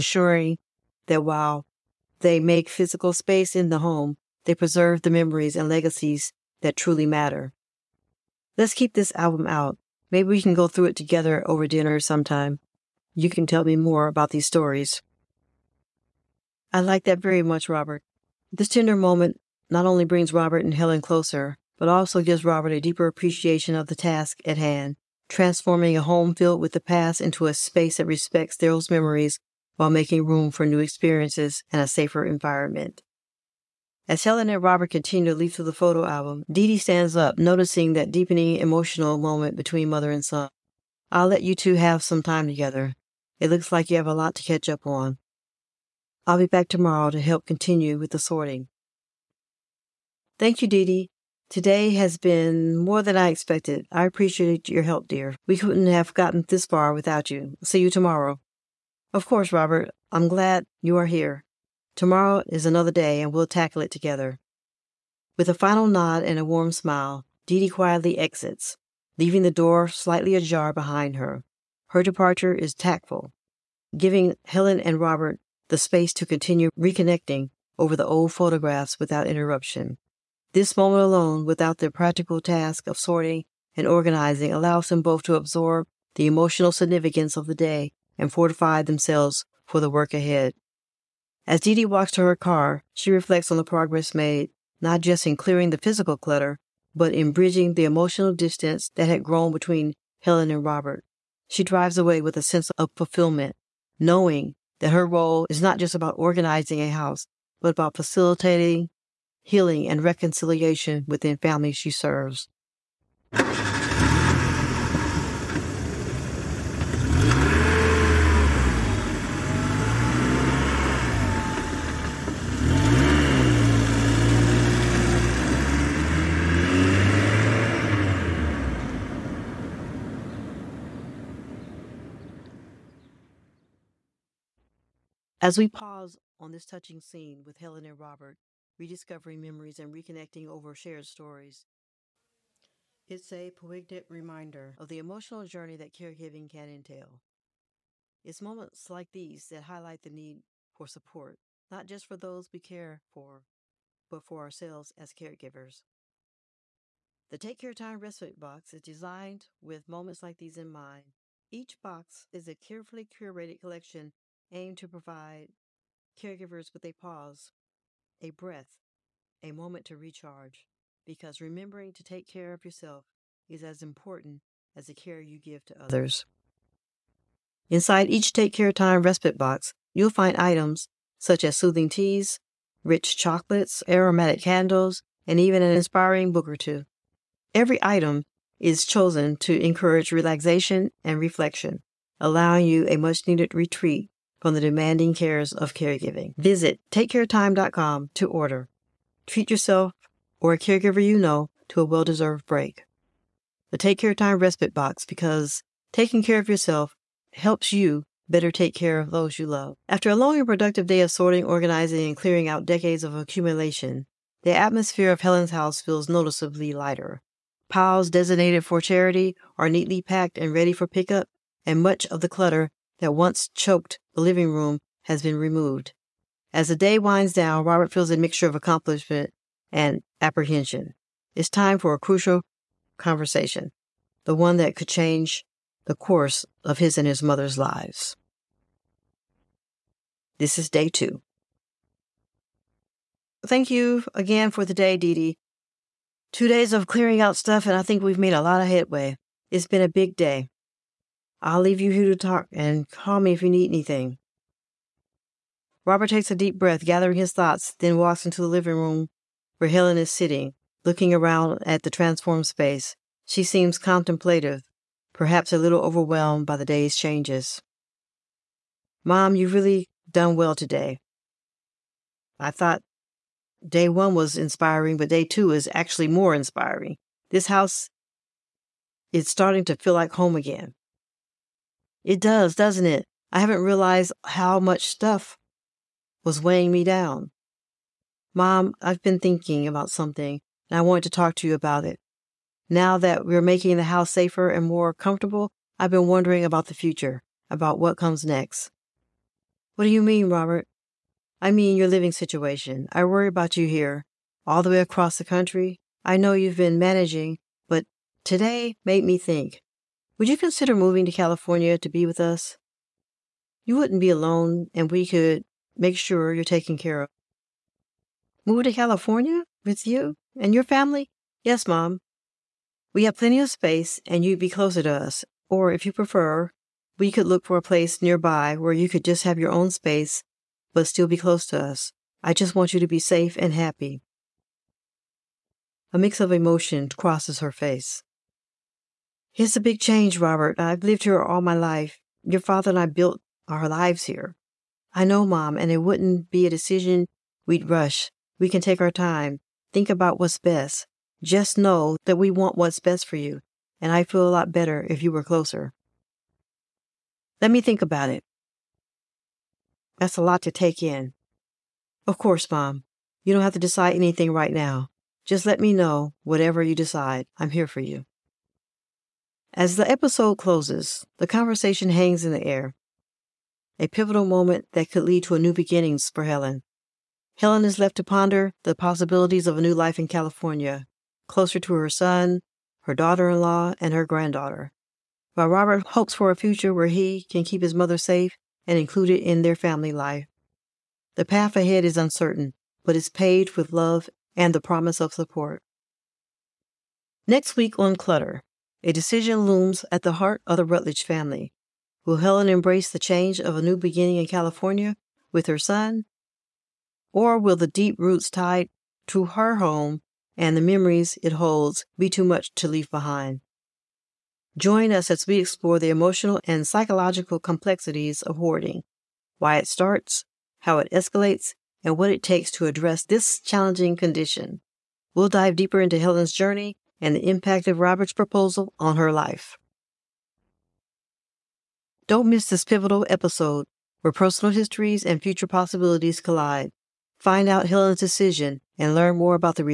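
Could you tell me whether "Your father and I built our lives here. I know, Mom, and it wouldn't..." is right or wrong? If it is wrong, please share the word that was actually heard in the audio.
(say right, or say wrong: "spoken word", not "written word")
right.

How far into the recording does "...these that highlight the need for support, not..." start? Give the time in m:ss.
2:29.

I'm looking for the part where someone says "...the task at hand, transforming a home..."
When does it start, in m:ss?
0:23.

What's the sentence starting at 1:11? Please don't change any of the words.
Her departure is tactful, giving Helen and Robert the space to continue reconnecting over the old photographs without interruption.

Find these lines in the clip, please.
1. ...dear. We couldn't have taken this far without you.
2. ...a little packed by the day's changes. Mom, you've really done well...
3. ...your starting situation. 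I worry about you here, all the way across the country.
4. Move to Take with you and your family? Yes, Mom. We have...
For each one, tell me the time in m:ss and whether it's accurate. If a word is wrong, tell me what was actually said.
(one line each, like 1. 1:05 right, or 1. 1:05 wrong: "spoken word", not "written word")
1. 0:55 wrong: "gotten", not "taken"
2. 4:25 wrong: "overwhelmed", not "packed"
3. 5:01 wrong: "living", not "starting"
4. 5:18 wrong: "California", not "Take".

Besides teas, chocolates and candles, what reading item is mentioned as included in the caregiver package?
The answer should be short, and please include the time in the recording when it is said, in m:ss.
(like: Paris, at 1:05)
an inspiring book, at 3:05.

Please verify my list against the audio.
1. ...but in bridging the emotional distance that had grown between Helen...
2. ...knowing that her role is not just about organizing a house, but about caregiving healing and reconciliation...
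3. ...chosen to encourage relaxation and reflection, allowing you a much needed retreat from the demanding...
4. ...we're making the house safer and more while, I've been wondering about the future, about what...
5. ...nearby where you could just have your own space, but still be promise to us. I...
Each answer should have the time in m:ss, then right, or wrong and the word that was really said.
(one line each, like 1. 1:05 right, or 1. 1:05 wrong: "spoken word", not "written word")
1. 1:36 right
2. 1:43 wrong: "facilitating", not "caregiving"
3. 3:08 right
4. 4:53 wrong: "comfortable", not "while"
5. 5:28 wrong: "close", not "promise".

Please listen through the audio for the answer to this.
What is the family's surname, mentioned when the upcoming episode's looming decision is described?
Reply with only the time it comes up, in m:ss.
6:40.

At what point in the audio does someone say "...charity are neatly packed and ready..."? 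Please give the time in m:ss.
3:38.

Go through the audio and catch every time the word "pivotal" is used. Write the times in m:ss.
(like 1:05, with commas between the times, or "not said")
6:13, 7:12.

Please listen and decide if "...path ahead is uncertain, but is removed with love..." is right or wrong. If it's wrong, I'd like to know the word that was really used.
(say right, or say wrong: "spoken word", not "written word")
wrong: "paved", not "removed".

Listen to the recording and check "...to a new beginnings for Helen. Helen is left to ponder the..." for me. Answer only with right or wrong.
right.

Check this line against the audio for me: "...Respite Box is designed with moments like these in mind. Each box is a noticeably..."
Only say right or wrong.
wrong.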